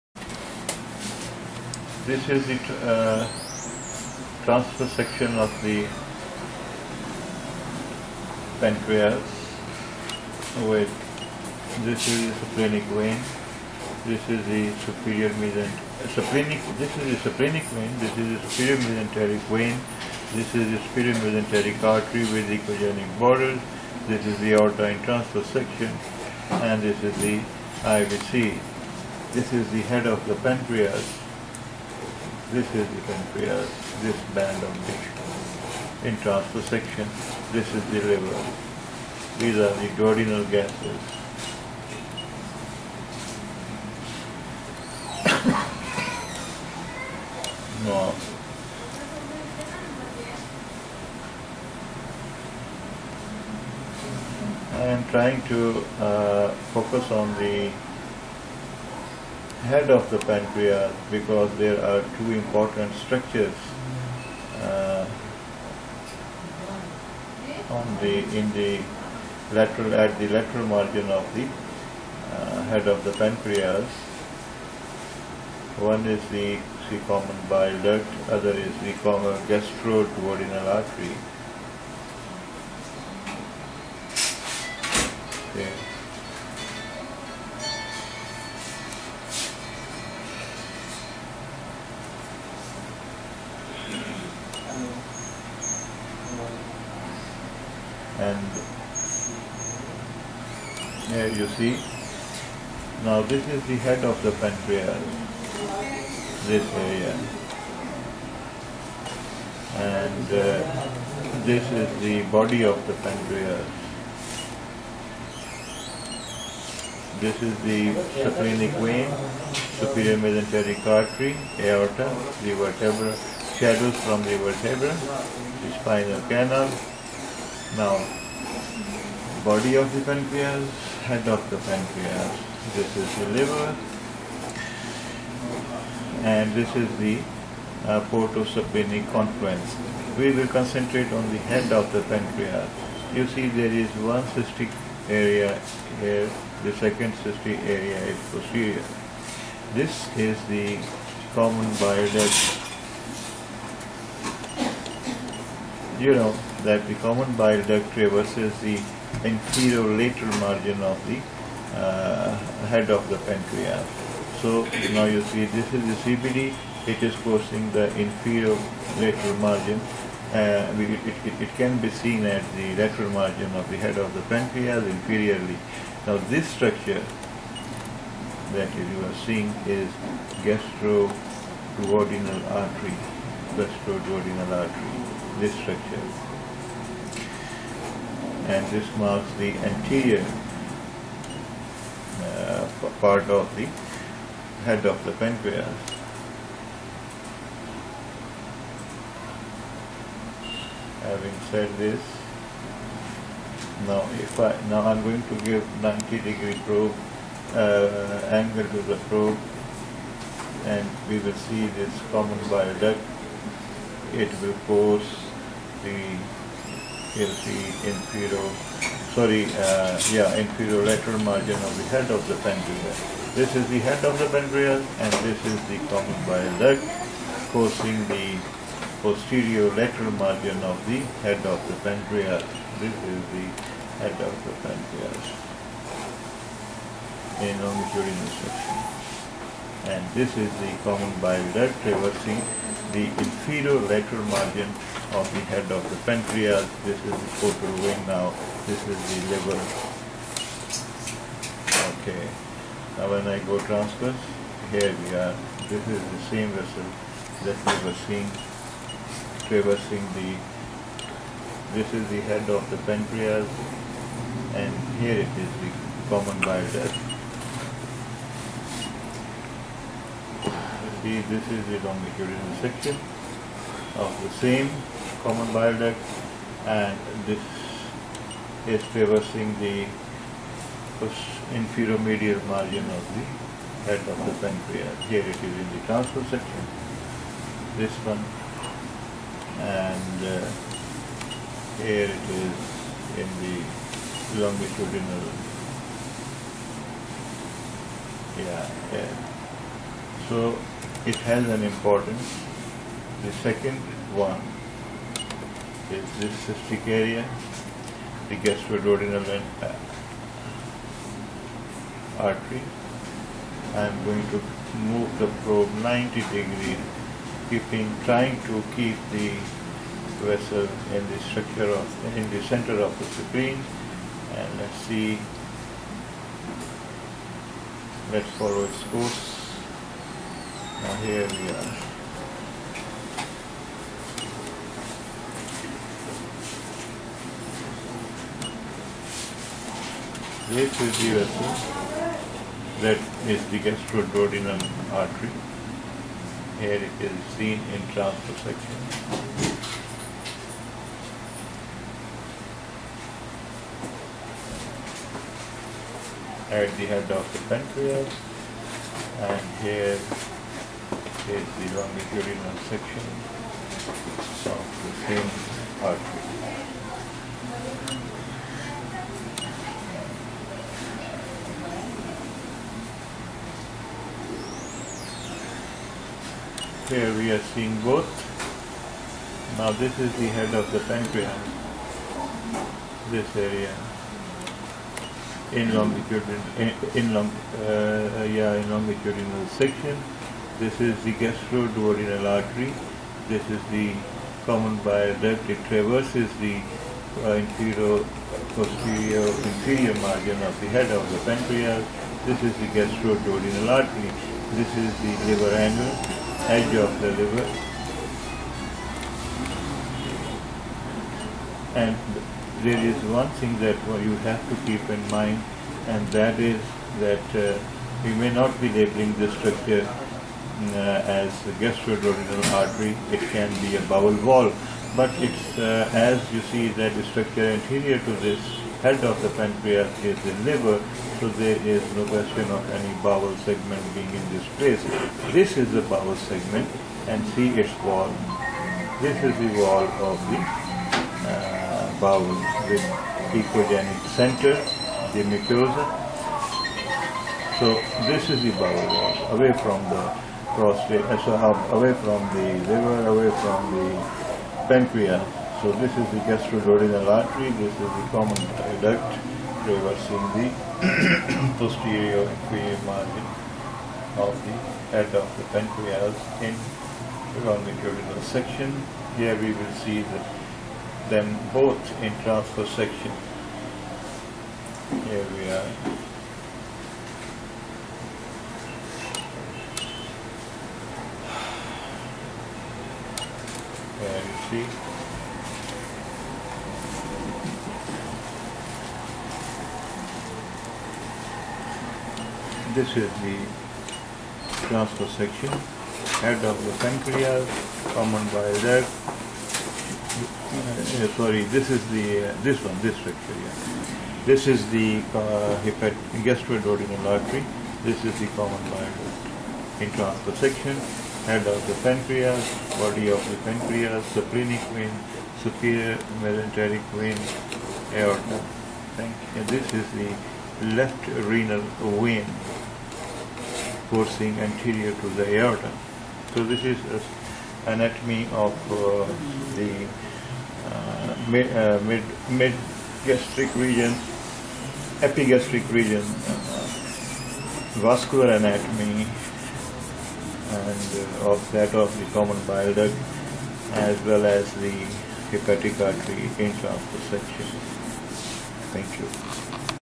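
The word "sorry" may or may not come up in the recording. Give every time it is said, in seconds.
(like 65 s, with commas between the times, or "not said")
219 s, 501 s.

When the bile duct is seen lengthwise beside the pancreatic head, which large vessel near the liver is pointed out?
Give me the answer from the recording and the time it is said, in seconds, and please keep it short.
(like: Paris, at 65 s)
Portal vein, at 247 s.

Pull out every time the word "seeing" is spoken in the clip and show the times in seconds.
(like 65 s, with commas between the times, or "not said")
179 s, 258 s, 377 s.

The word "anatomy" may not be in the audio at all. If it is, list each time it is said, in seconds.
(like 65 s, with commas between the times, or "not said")
527 s, 538 s.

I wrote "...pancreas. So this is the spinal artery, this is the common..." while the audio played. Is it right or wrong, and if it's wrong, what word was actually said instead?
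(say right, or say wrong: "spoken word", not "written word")
wrong: "gastroduodenal", not "spinal".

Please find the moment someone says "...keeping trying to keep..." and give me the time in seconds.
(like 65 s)
317 s.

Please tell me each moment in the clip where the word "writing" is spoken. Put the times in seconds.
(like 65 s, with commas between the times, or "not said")
not said.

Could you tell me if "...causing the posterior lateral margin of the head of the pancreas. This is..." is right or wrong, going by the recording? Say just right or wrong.
right.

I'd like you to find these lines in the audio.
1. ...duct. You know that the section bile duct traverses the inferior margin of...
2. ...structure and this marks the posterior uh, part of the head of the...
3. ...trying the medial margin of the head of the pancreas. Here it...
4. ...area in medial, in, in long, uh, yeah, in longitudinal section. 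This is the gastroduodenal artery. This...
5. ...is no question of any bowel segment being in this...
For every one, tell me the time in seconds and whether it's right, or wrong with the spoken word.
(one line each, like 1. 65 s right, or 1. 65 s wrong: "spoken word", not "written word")
1. 152 s wrong: "common", not "section"
2. 185 s wrong: "anterior", not "posterior"
3. 278 s wrong: "traversing", not "trying"
4. 383 s wrong: "longitudinal", not "medial"
5. 431 s right.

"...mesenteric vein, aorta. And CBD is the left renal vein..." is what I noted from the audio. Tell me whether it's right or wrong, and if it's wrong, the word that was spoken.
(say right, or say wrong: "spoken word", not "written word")
wrong: "This", not "CBD".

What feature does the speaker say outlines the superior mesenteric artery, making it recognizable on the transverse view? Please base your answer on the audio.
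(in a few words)
Echogenic borders.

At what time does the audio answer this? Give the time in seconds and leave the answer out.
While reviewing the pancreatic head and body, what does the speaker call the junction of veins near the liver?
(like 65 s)
138 s.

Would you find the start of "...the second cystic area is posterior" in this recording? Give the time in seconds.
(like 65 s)
146 s.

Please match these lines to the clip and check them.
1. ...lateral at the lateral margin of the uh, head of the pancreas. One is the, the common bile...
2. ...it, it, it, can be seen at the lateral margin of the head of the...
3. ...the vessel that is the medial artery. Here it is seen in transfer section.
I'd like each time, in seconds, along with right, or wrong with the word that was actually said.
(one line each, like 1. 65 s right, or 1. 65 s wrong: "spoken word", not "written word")
1. 69 s right
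2. 170 s right
3. 340 s wrong: "gastroduodenal", not "medial".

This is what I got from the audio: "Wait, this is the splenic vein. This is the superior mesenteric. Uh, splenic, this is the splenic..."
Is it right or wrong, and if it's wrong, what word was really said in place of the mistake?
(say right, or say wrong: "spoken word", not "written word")
right.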